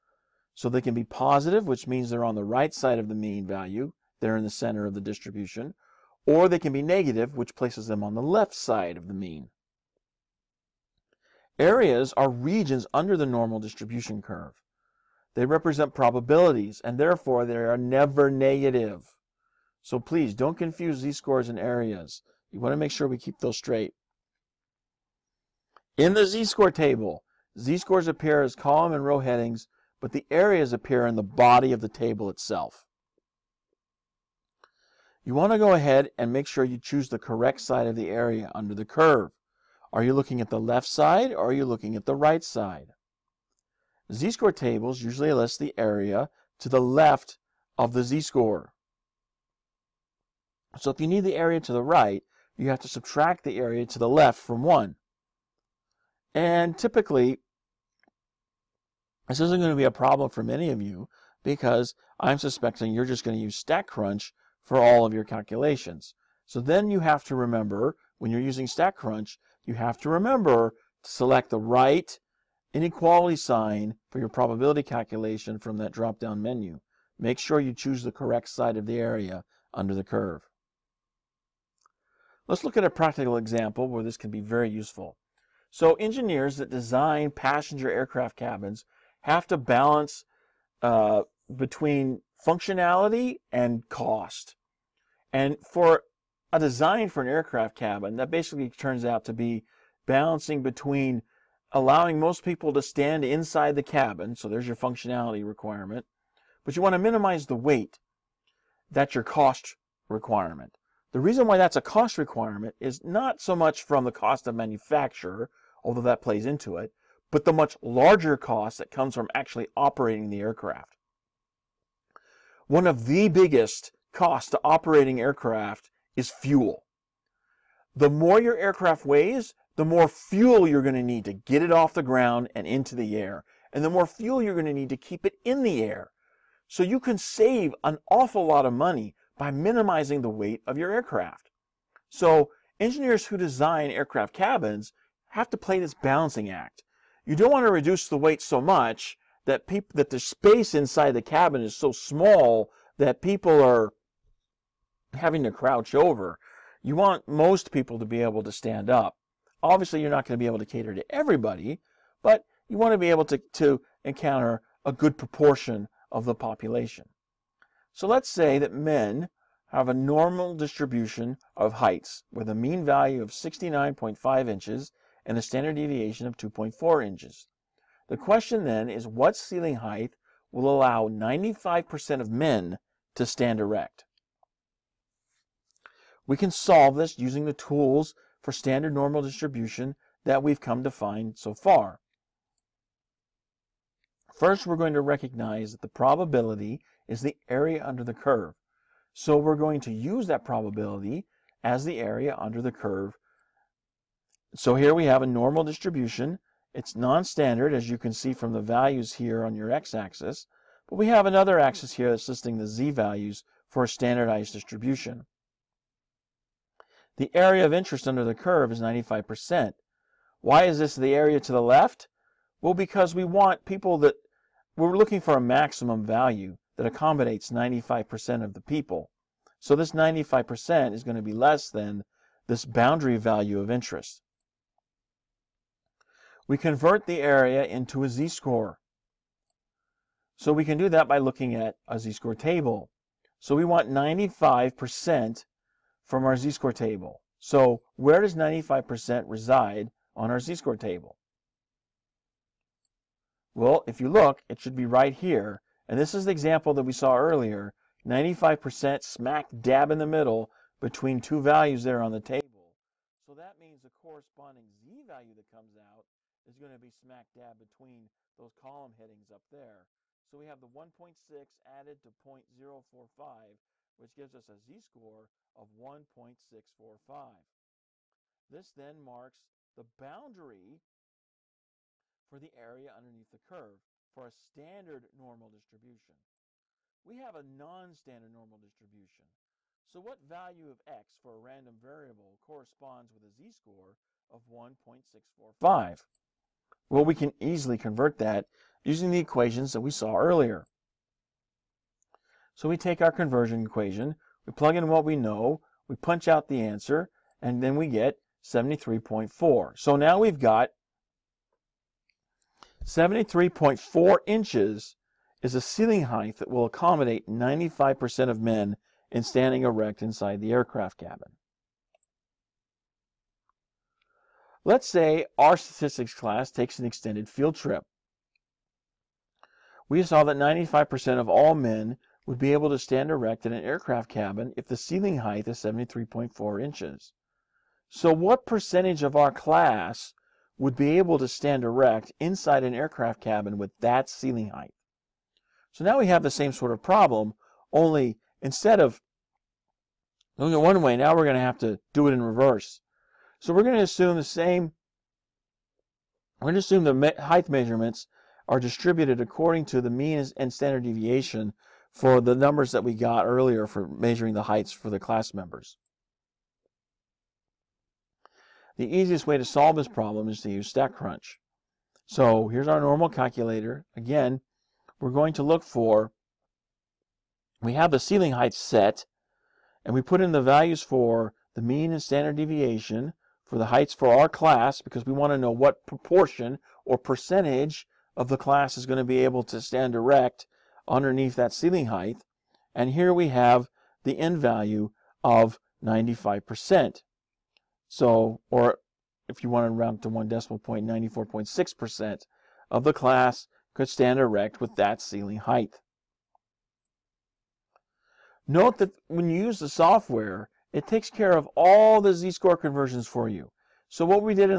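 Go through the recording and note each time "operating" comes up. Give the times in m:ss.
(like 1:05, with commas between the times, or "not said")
1:59, 2:04.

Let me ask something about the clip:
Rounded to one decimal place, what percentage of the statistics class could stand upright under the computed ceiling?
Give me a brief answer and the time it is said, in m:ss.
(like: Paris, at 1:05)
94.6%, at 6:40.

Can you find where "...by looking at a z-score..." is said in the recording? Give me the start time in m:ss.
4:01.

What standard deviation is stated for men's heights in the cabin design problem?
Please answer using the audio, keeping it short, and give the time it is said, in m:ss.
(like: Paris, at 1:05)
2.4 inches, at 2:56.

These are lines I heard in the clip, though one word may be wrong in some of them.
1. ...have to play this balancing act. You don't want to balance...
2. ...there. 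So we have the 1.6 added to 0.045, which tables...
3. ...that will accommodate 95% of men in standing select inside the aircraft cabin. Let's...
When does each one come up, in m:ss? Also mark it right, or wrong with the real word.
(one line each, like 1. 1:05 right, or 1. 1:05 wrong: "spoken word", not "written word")
1. 2:25 wrong: "reduce", not "balance"
2. 4:29 wrong: "gives", not "tables"
3. 5:16 wrong: "erect", not "select".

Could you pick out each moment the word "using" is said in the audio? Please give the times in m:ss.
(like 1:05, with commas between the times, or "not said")
1:08, 3:07, 4:58.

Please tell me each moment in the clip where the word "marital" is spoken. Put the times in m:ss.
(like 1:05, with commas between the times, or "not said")
not said.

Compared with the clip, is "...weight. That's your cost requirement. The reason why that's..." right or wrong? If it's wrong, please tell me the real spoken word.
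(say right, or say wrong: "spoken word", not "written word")
right.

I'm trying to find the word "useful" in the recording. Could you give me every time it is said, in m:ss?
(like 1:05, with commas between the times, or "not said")
1:24.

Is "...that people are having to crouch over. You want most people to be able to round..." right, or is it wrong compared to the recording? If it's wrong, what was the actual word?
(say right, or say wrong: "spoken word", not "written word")
wrong: "stand", not "round".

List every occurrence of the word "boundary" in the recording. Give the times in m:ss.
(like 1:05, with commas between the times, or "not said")
3:52, 4:39.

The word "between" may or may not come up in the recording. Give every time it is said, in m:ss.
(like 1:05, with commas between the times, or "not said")
1:31, 1:40, 4:20, 4:27.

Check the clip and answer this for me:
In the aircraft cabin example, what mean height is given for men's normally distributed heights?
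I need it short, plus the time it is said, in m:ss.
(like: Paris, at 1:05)
69.5 inches, at 2:53.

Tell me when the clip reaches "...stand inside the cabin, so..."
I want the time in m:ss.
1:42.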